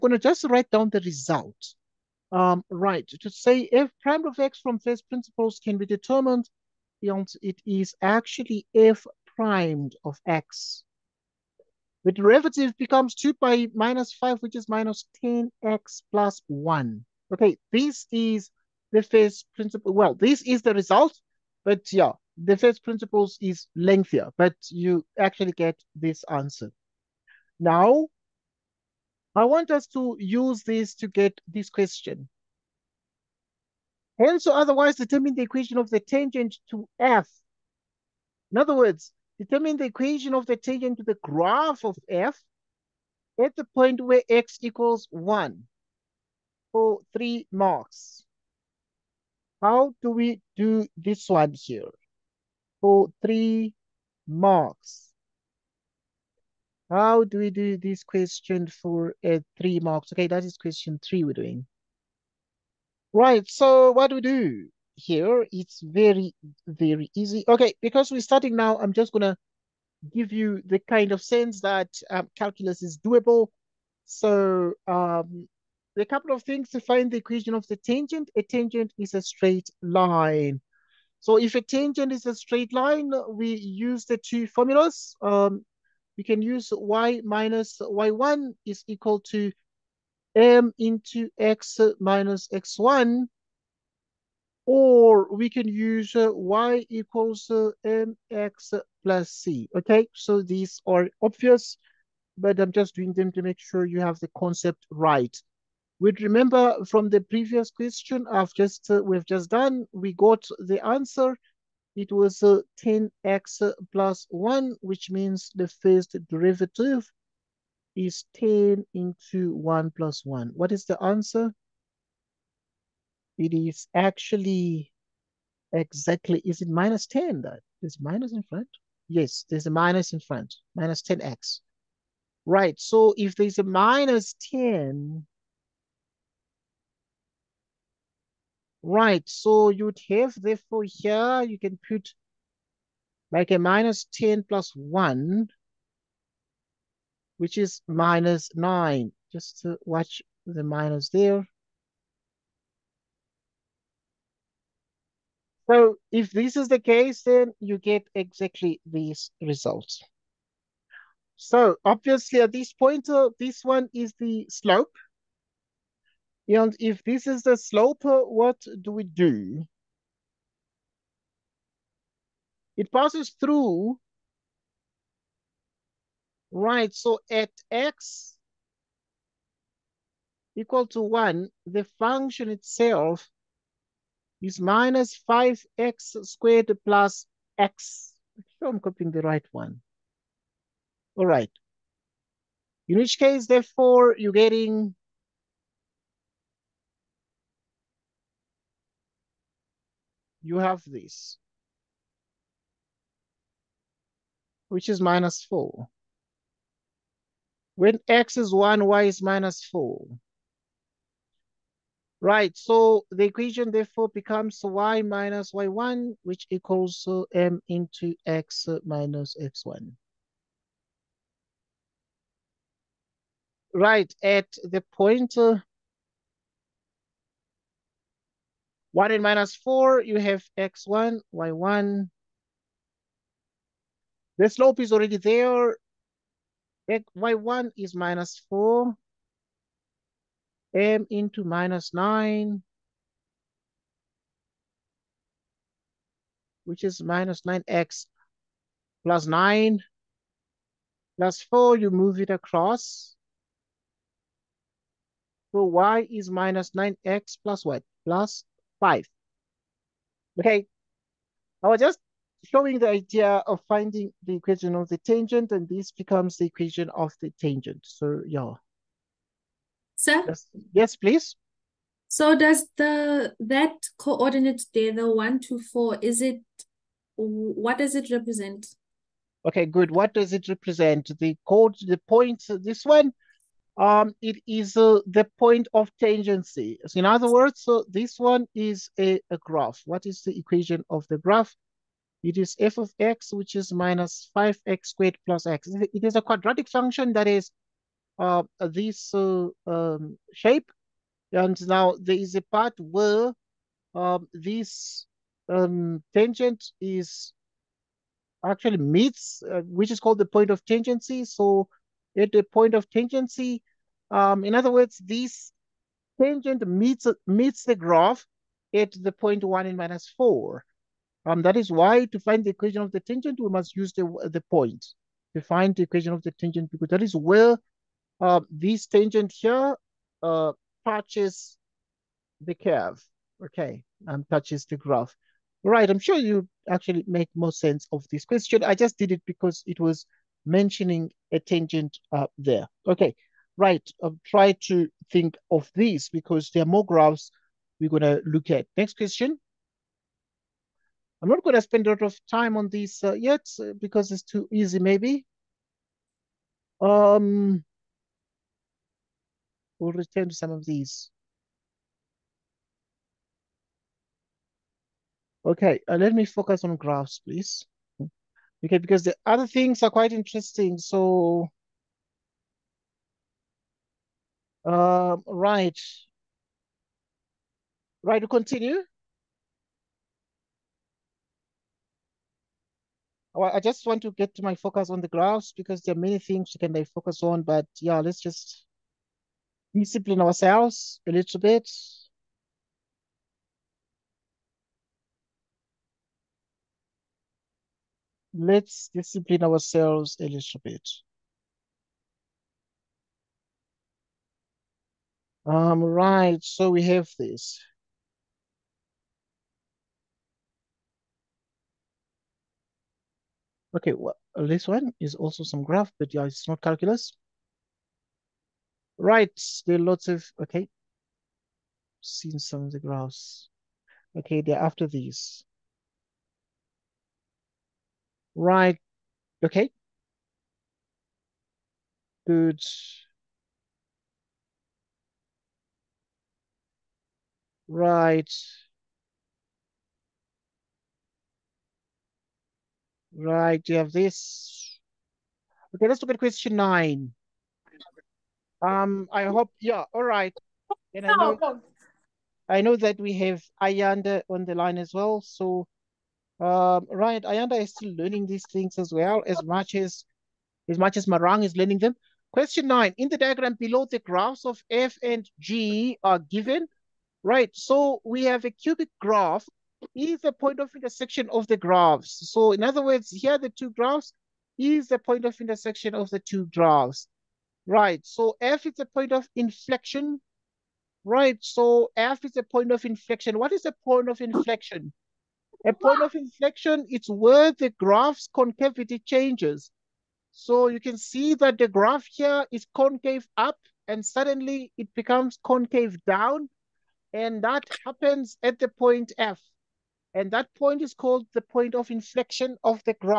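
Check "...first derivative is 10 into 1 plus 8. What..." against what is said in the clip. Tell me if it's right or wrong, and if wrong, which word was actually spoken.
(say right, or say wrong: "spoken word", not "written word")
wrong: "1", not "8".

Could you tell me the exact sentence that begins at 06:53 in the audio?
Okay, well, this one is also some graph, but yeah, it's not calculus.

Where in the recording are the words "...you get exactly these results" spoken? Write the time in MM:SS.
02:37.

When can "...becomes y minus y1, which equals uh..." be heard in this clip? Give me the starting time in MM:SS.
03:34.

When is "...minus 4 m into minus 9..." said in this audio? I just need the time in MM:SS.
03:57.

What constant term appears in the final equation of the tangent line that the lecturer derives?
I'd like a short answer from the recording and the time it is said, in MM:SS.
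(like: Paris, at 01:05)
5, at 04:18.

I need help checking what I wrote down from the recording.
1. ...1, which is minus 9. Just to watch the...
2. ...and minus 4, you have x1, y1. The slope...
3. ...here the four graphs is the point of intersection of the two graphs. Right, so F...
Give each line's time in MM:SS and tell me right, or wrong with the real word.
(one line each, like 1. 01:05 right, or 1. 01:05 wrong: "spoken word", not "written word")
1. 02:24 right
2. 03:49 right
3. 07:53 wrong: "two", not "four".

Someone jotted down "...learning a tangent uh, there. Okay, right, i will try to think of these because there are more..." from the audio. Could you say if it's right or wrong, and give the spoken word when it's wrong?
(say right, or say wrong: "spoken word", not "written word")
wrong: "mentioning", not "learning".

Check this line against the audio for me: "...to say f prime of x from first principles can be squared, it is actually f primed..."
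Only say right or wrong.
wrong.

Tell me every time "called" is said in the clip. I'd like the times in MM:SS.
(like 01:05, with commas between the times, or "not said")
05:09, 08:20.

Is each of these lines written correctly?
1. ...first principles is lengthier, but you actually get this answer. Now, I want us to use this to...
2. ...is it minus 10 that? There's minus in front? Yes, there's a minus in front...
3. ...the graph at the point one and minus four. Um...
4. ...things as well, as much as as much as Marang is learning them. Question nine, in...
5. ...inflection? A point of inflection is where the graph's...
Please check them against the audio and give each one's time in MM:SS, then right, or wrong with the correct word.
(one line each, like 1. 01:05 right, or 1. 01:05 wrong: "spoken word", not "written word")
1. 00:22 right
2. 02:06 right
3. 05:17 right
4. 07:38 right
5. 08:04 right.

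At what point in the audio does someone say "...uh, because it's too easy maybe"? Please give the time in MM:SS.
05:53.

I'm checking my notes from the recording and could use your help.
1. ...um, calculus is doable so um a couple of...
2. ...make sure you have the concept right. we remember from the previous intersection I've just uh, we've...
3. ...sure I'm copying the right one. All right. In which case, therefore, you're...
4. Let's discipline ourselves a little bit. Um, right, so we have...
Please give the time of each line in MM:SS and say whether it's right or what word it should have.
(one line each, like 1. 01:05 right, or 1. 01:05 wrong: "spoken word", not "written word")
1. 01:12 right
2. 01:43 wrong: "question", not "intersection"
3. 03:08 right
4. 06:38 right.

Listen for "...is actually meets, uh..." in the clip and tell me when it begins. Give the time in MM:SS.
05:06.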